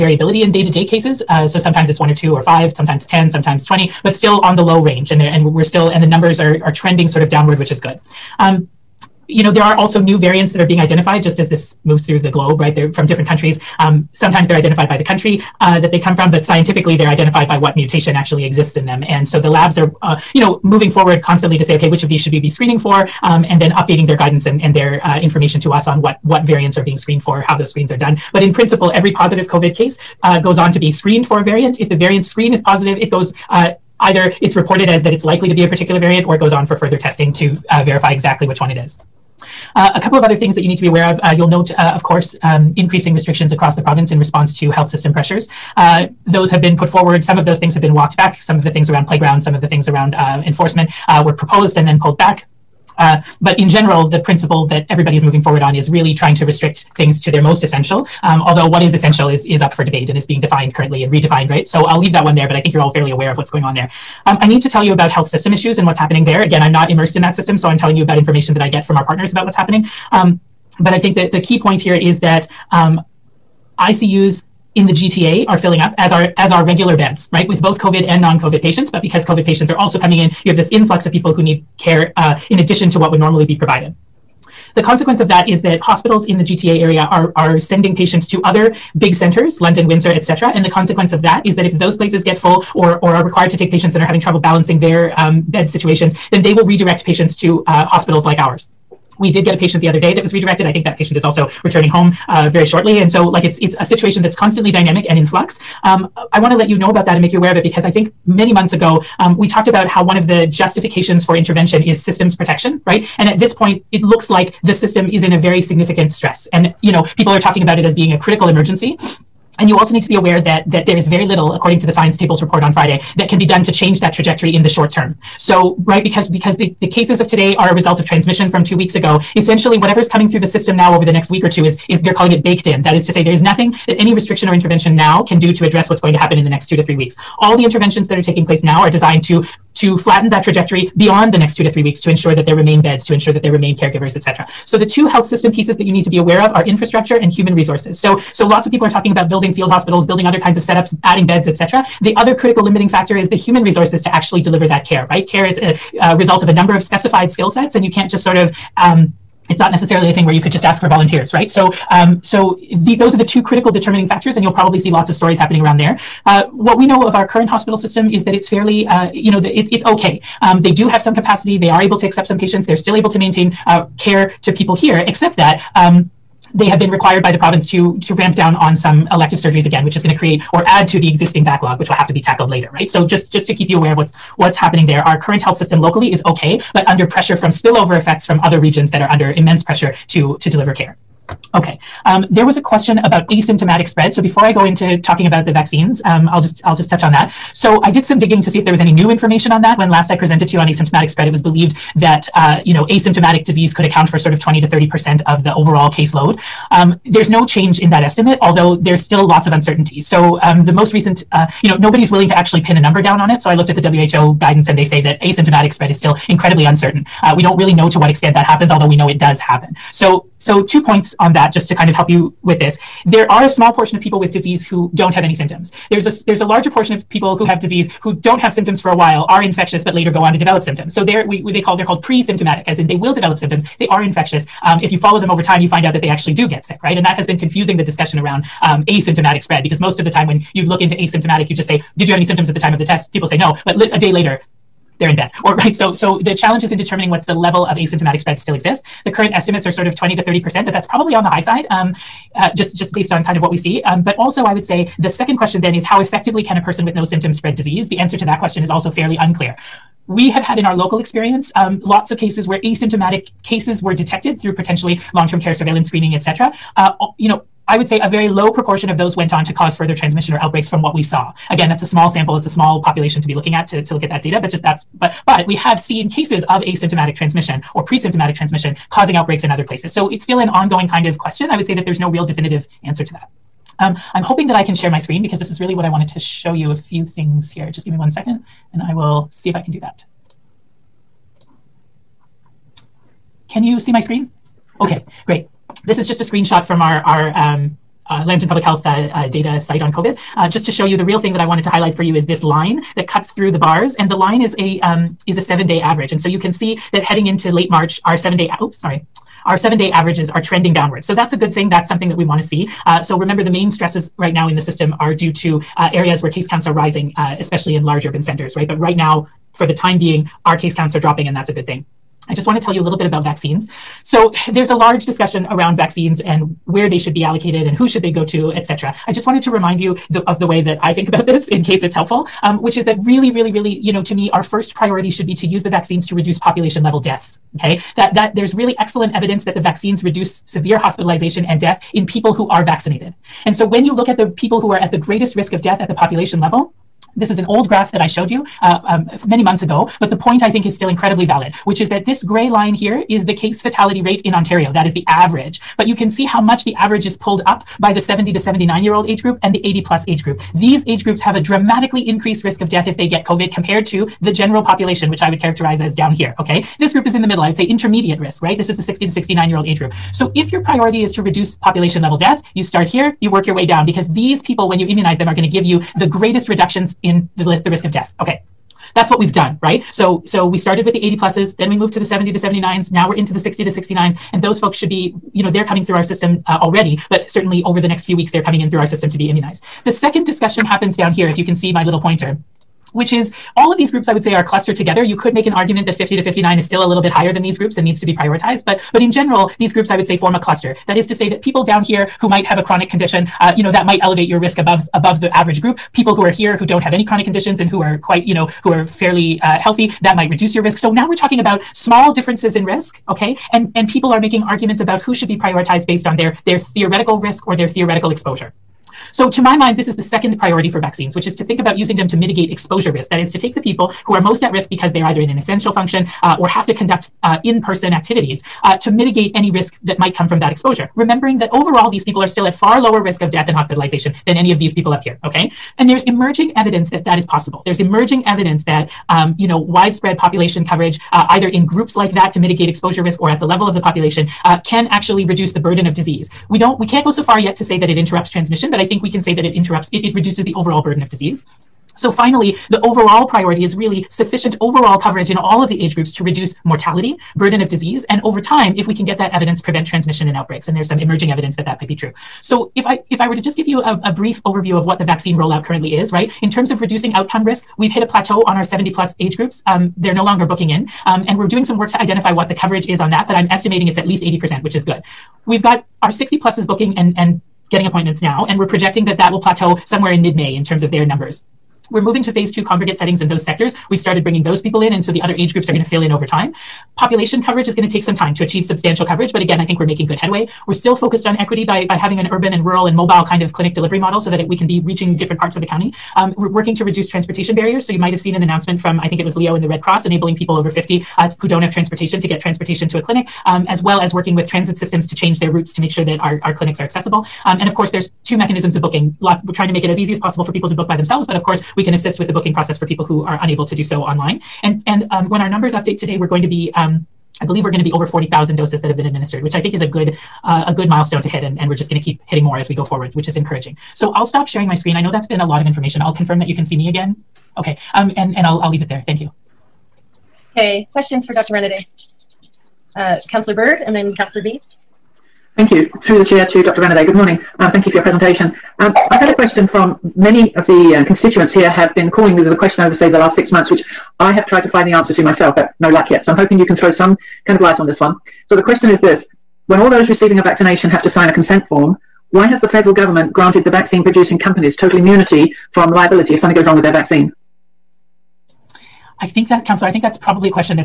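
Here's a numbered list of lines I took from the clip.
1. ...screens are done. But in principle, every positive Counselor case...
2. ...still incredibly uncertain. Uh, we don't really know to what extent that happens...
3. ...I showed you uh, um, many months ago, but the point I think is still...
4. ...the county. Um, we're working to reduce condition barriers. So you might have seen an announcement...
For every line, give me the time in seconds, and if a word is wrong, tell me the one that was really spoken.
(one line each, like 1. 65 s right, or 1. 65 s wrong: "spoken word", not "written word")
1. 27 s wrong: "COVID", not "Counselor"
2. 215 s right
3. 347 s right
4. 495 s wrong: "transportation", not "condition".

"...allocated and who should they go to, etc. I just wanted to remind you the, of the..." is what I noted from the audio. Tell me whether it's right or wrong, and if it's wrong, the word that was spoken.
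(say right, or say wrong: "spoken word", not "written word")
right.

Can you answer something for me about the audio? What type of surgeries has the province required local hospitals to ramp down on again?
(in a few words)
elective surgeries.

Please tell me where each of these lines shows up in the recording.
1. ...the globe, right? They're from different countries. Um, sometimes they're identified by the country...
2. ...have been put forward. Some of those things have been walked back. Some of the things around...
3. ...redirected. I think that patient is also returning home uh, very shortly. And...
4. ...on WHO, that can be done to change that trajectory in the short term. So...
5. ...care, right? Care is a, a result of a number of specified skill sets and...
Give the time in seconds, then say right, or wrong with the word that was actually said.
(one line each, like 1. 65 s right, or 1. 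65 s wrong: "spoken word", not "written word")
1. 12 s right
2. 46 s right
3. 100 s right
4. 122 s wrong: "Friday", not "WHO"
5. 154 s right.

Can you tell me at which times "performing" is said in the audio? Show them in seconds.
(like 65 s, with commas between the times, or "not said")
not said.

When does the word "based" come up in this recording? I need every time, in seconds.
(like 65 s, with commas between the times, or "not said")
252 s, 415 s.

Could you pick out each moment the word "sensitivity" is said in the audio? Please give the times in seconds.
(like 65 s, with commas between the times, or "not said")
not said.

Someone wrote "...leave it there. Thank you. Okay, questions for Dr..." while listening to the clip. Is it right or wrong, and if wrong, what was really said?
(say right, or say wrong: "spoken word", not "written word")
right.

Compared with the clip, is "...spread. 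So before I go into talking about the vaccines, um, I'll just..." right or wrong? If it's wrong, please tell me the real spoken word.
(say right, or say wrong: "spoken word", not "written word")
right.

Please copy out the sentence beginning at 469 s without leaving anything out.
Um, they're no longer booking in.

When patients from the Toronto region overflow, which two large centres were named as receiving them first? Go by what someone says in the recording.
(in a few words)
London, Windsor.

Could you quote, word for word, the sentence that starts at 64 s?
Um, I need to tell you about health system issues and what's happening there.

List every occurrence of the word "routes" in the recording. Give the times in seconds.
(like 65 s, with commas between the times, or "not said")
505 s.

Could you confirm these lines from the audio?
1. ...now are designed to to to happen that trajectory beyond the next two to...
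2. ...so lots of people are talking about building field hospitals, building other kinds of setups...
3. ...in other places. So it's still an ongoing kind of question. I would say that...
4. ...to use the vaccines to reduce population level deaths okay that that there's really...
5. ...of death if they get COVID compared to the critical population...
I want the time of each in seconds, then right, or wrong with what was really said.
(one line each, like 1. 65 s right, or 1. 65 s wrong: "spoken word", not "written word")
1. 138 s wrong: "flatten", not "happen"
2. 148 s right
3. 279 s right
4. 335 s right
5. 362 s wrong: "general", not "critical".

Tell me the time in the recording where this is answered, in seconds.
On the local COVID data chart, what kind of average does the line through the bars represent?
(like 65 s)
305 s.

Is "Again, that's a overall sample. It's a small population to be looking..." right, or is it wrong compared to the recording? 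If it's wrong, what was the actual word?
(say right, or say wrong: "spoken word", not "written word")
wrong: "small", not "overall".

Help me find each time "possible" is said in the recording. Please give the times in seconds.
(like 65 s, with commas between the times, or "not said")
437 s, 510 s.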